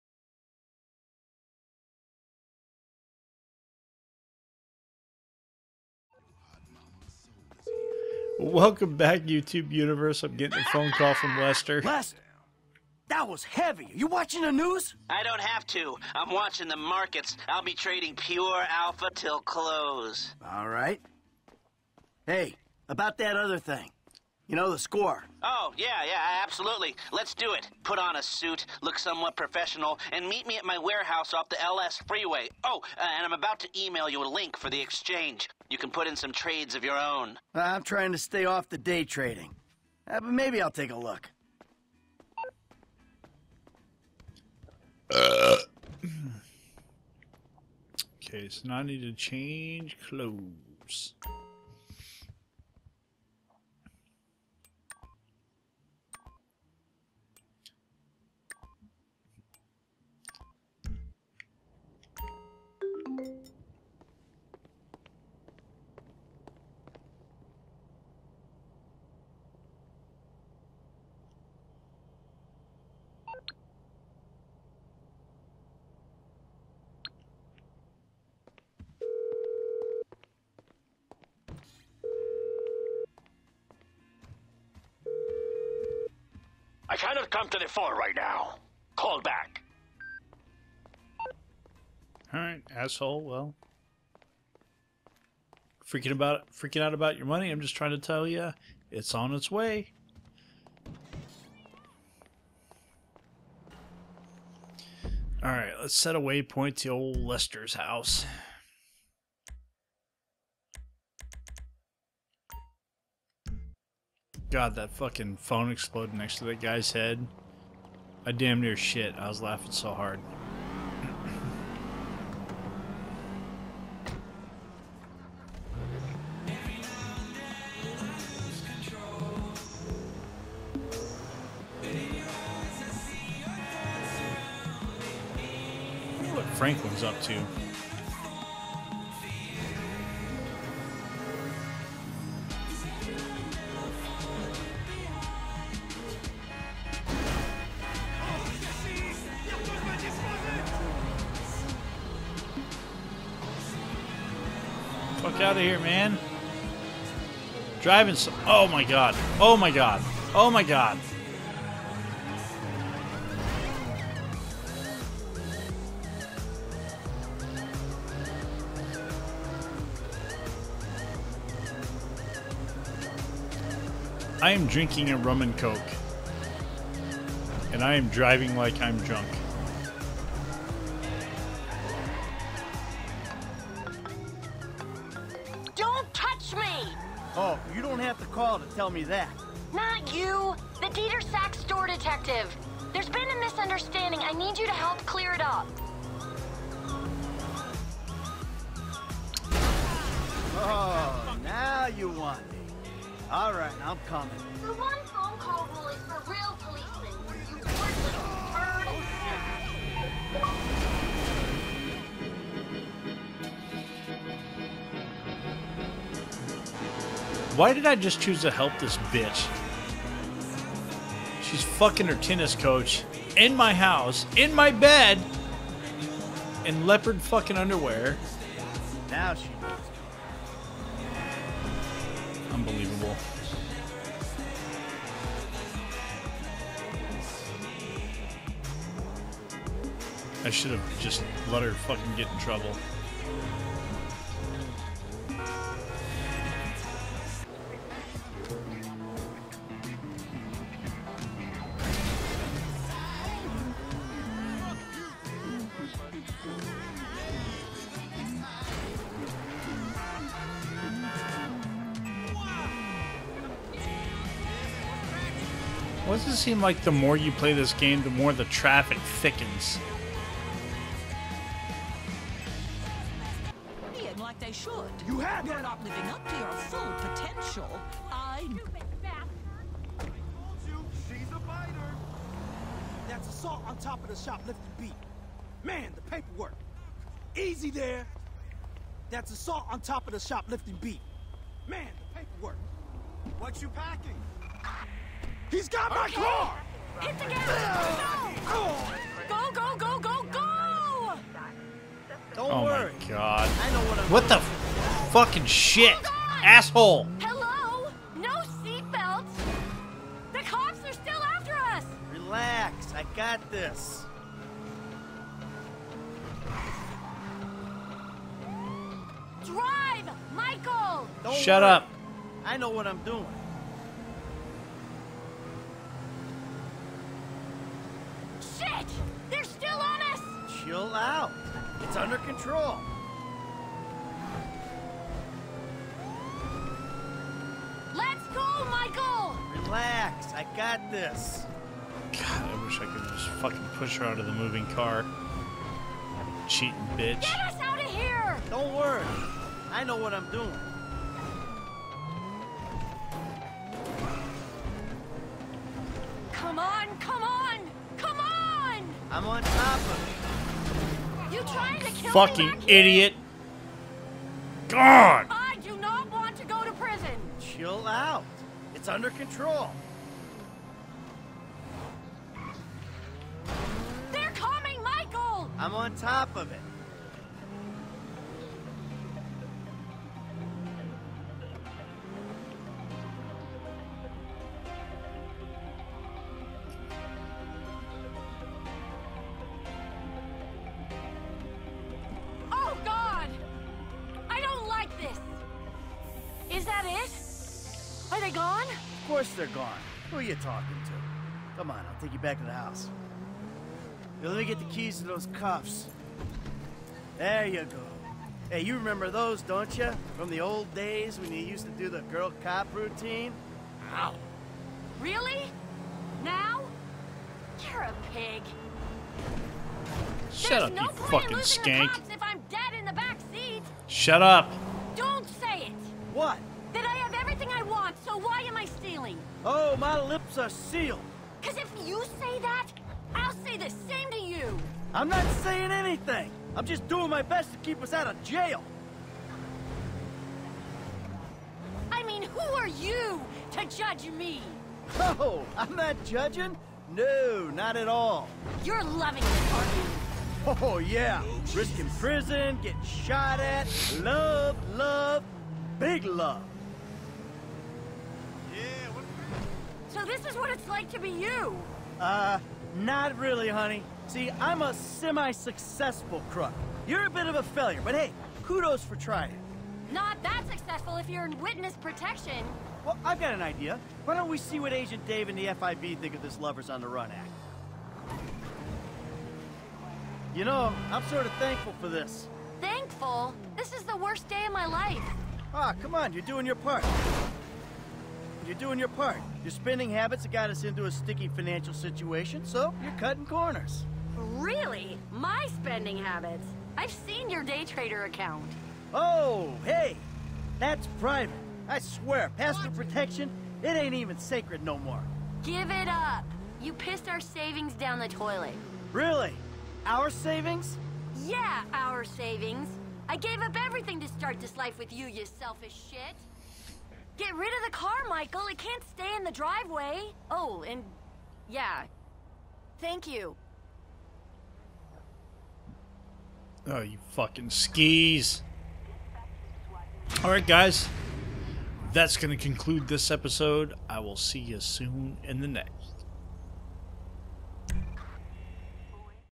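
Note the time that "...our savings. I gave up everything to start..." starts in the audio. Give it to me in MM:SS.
08:31.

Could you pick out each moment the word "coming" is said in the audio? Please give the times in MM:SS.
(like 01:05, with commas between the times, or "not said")
03:24, 06:14.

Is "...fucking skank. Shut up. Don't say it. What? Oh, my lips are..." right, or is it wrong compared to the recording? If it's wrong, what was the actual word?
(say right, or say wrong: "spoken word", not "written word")
right.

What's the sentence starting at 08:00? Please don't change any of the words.
You know, I'm sort of thankful for this.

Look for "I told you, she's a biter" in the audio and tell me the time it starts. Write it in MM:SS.
04:38.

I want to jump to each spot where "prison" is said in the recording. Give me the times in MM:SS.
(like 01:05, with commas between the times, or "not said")
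06:06, 07:31.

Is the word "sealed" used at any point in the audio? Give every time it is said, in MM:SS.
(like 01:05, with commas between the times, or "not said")
07:10.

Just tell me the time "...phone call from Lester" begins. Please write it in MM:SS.
00:10.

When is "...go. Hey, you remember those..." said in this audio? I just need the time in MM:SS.
06:47.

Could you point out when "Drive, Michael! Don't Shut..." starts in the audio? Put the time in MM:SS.
05:19.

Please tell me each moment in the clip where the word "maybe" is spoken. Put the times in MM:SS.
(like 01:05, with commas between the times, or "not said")
00:40.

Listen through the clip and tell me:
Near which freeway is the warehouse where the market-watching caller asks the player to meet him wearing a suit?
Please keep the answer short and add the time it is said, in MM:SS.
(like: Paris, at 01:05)
LS freeway, at 00:31.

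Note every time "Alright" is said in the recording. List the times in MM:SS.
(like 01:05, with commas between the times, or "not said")
01:32, 01:45, 08:50.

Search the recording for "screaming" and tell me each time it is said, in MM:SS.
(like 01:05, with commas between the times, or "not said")
not said.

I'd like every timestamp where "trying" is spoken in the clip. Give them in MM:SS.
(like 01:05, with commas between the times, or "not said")
00:37, 01:37, 06:01, 07:48.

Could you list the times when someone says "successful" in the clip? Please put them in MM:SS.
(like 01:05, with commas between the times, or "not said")
07:44, 07:50.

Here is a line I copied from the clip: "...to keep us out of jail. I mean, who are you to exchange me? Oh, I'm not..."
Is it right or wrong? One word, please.
wrong.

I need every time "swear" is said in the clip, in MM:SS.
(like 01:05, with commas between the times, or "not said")
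08:21.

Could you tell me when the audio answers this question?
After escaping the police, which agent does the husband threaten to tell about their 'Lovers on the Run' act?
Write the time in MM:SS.
07:54.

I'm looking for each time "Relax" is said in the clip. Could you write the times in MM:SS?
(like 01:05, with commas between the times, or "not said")
05:12, 05:39.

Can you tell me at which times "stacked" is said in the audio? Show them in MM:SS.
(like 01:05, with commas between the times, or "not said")
not said.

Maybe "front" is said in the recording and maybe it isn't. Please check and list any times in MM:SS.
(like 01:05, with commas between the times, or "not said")
not said.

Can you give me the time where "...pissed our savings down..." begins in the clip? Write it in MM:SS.
08:26.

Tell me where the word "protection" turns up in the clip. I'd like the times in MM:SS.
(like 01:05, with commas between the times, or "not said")
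07:51, 08:22.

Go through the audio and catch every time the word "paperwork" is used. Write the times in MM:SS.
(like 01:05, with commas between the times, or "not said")
04:46, 04:52.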